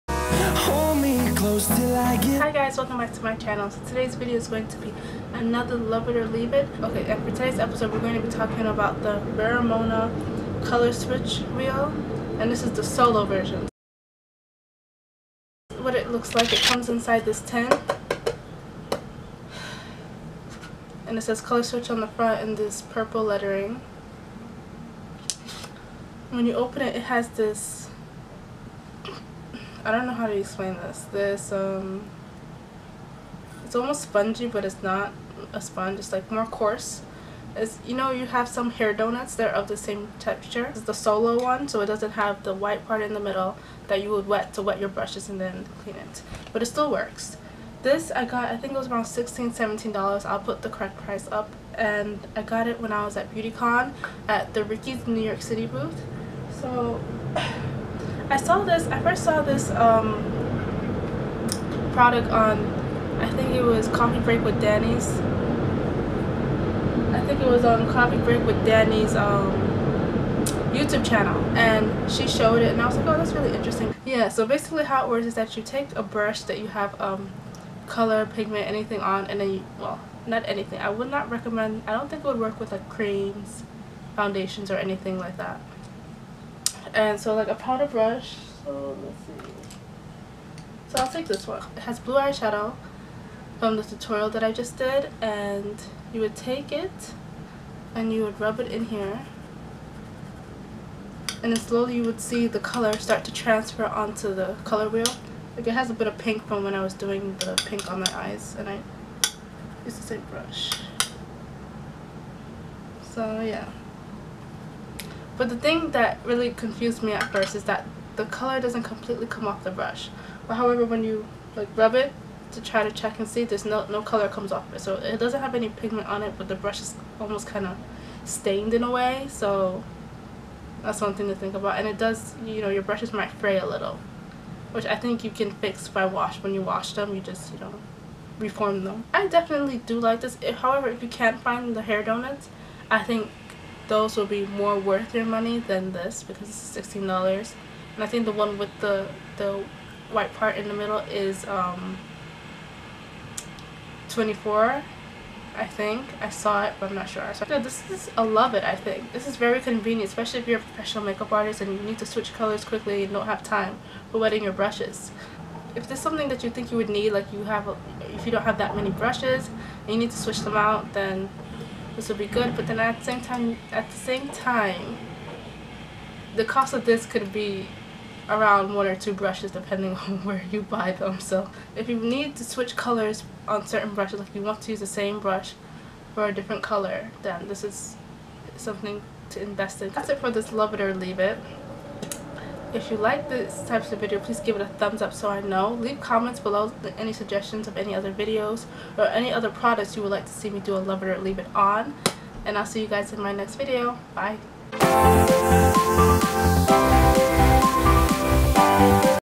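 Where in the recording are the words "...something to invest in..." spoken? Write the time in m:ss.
3:08.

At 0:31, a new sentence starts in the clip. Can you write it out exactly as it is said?
This, um, it's almost spongy, but it's not a sponge.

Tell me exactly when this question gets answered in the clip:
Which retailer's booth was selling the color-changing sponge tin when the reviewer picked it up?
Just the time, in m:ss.
0:54.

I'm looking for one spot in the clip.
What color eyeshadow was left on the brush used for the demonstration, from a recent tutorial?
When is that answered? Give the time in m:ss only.
1:31.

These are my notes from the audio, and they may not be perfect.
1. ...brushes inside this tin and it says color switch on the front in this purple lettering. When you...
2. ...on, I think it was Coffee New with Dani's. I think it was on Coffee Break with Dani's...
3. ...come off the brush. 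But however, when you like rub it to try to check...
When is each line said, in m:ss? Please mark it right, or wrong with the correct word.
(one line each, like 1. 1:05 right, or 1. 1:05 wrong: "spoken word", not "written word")
1. 0:16 wrong: "comes", not "brushes"
2. 1:02 wrong: "Break", not "New"
3. 1:59 right.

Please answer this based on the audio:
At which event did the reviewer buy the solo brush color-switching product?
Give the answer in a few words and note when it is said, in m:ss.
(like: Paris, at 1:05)
BeautyCon, at 0:53.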